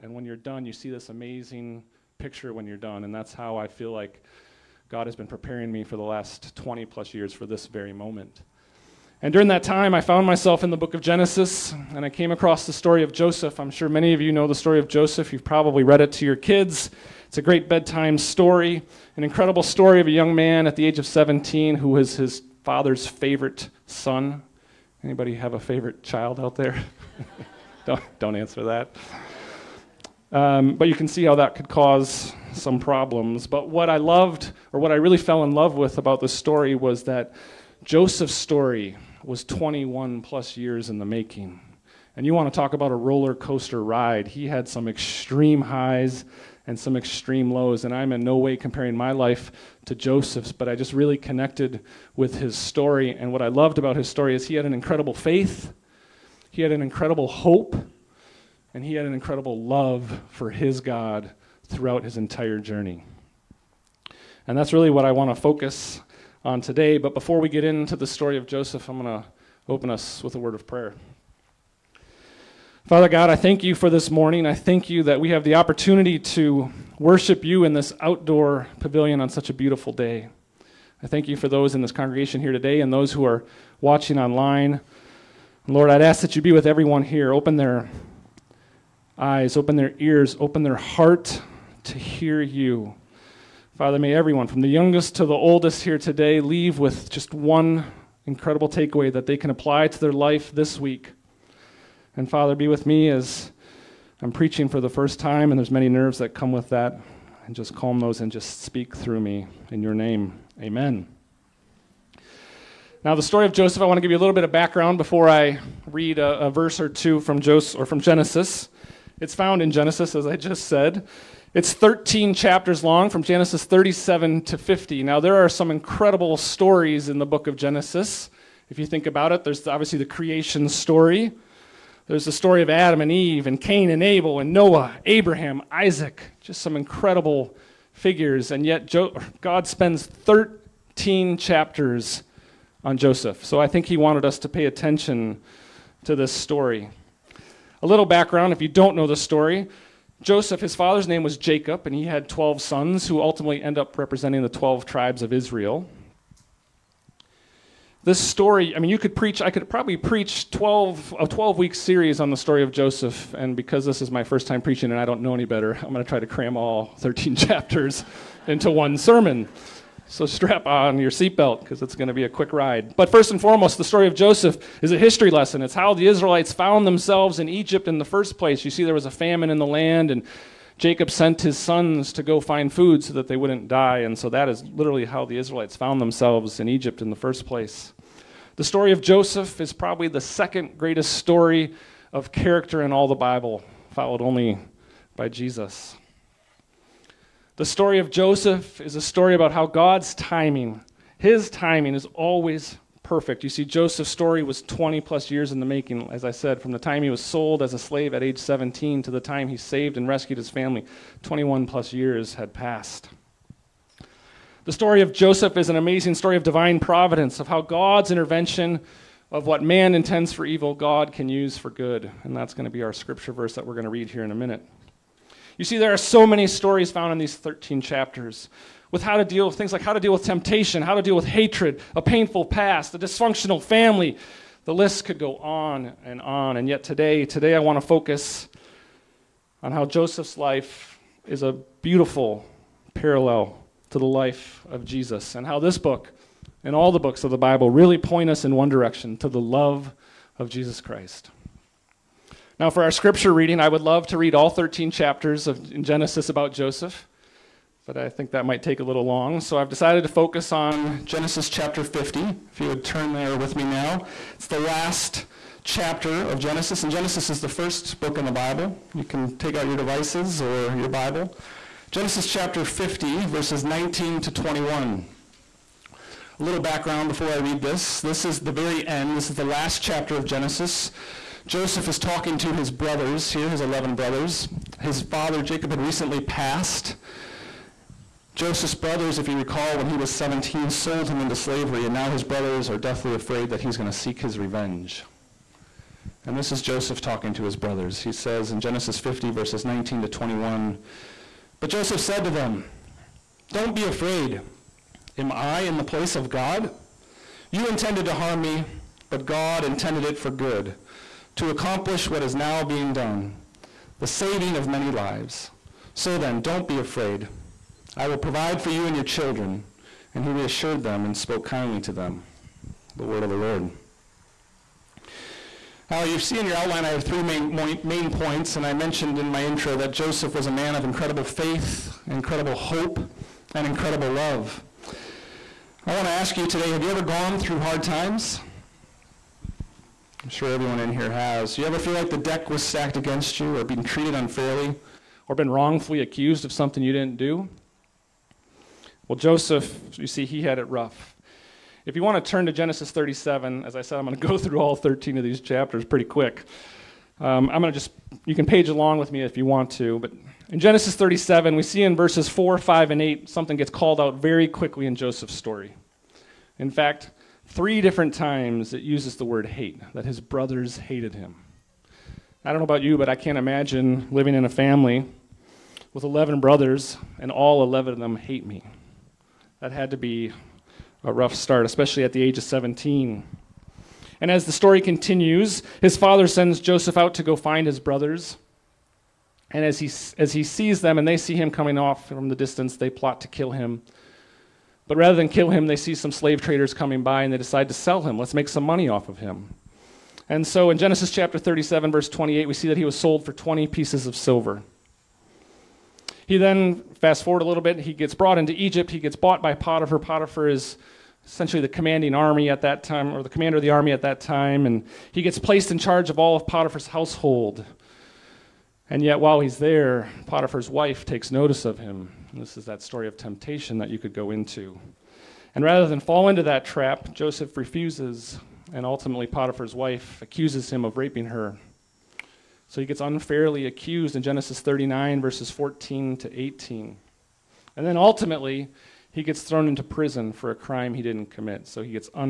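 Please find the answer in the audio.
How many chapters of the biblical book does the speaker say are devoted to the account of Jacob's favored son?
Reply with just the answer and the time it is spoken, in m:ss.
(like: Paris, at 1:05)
13, at 2:01.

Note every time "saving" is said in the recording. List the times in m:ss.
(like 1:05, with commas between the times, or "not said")
5:14.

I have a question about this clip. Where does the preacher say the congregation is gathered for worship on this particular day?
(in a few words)
outdoor pavilion.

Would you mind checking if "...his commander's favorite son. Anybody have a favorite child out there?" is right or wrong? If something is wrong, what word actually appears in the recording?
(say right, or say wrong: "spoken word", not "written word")
wrong: "father", not "commander".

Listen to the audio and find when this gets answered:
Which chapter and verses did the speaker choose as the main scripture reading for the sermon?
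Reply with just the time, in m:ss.
4:31.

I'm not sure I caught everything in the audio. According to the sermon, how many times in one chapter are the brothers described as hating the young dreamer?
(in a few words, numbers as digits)
3.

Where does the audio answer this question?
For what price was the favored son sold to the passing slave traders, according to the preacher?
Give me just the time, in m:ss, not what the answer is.
6:43.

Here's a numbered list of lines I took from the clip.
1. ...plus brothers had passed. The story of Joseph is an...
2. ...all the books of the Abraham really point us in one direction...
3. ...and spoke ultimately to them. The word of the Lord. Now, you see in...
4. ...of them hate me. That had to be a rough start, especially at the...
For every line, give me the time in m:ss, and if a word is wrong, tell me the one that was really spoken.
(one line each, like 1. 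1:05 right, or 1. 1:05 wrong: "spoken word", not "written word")
1. 3:31 wrong: "years", not "brothers"
2. 4:06 wrong: "Bible", not "Abraham"
3. 5:21 wrong: "kindly", not "ultimately"
4. 6:17 right.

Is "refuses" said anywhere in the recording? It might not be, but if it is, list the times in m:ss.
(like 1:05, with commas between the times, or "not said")
7:07.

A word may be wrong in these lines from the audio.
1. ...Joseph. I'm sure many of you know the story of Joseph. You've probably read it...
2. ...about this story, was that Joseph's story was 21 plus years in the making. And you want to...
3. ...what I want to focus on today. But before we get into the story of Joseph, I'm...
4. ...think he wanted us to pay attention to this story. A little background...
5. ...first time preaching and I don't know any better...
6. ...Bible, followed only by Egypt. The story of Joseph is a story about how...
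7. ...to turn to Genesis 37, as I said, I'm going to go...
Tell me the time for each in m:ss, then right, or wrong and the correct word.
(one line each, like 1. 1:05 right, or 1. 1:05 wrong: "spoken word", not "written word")
1. 0:13 right
2. 0:35 right
3. 1:04 right
4. 2:23 right
5. 2:44 right
6. 3:13 wrong: "Jesus", not "Egypt"
7. 5:52 right.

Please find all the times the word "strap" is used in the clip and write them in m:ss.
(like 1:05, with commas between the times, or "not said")
2:50.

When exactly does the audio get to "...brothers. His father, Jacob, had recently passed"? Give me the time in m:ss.
4:43.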